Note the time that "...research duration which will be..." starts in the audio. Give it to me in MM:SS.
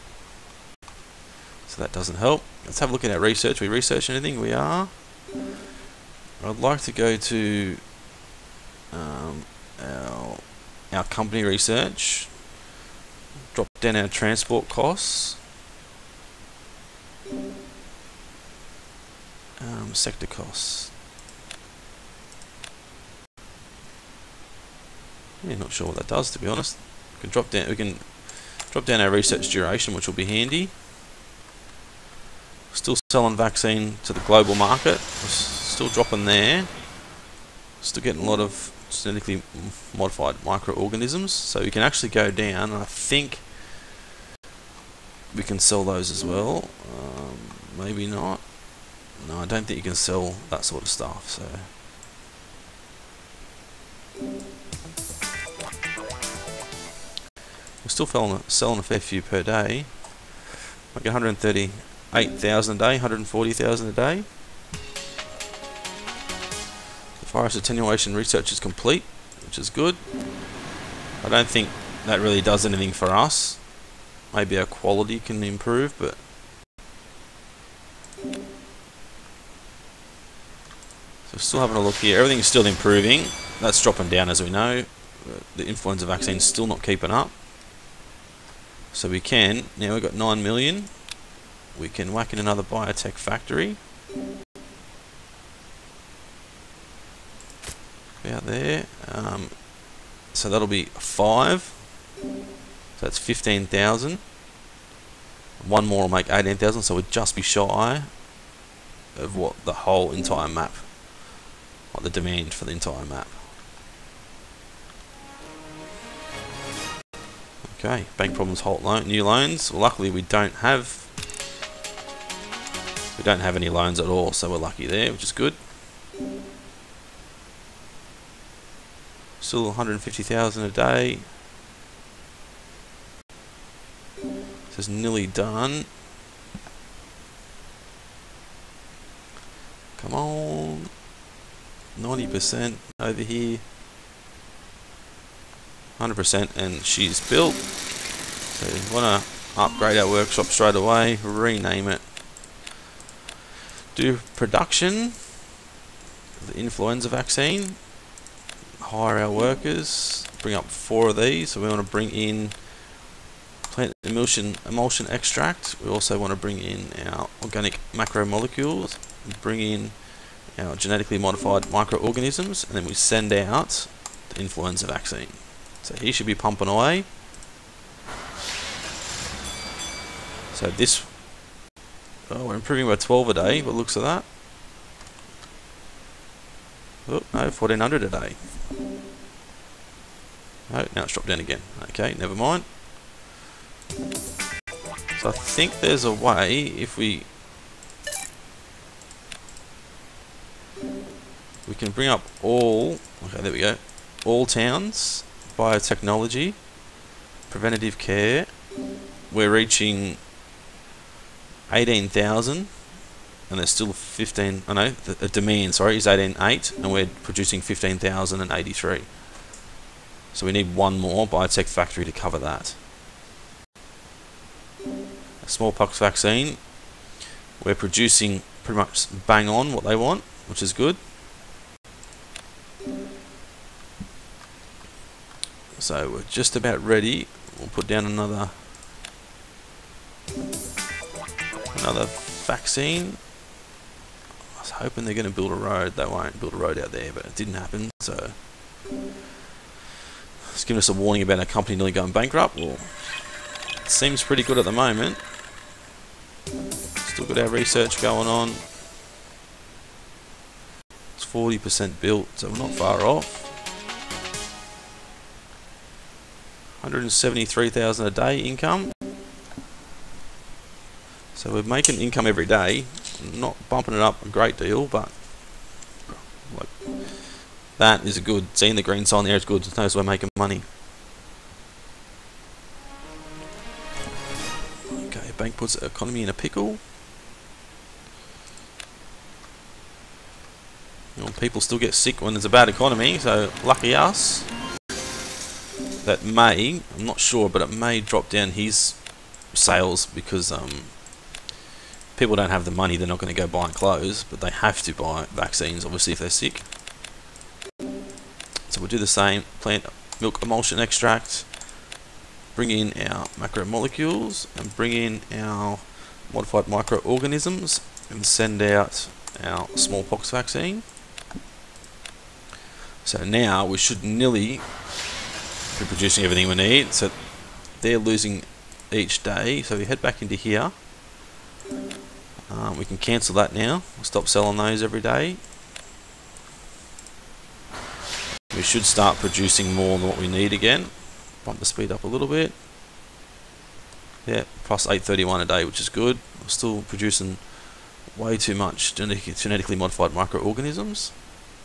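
00:29.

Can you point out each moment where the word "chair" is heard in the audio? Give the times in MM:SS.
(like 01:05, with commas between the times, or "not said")
not said.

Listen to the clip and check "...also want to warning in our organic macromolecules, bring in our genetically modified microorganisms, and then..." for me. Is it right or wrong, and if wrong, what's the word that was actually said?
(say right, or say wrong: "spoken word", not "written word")
wrong: "bring", not "warning".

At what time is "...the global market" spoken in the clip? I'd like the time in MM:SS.
00:34.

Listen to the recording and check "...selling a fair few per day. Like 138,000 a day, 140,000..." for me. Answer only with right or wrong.
right.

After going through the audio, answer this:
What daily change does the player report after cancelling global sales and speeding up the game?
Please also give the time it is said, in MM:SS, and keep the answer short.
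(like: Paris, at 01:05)
plus 831 a day, at 05:44.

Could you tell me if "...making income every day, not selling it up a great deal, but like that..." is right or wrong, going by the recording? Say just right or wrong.
wrong.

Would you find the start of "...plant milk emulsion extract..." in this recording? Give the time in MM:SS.
05:09.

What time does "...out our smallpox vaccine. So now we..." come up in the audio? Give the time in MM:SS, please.
05:18.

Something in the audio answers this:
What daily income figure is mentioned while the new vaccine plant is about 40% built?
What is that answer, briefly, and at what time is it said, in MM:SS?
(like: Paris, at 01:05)
173,000, at 04:26.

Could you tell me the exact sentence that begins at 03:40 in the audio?
So we need one more biotech factory to cover that.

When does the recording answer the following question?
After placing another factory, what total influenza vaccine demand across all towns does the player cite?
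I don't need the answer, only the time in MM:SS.
03:36.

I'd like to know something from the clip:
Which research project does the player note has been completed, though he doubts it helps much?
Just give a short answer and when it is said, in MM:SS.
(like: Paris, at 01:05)
Virus attenuation, at 01:07.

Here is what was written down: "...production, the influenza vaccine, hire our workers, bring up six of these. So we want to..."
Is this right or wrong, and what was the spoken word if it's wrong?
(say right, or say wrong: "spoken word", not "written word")
wrong: "four", not "six".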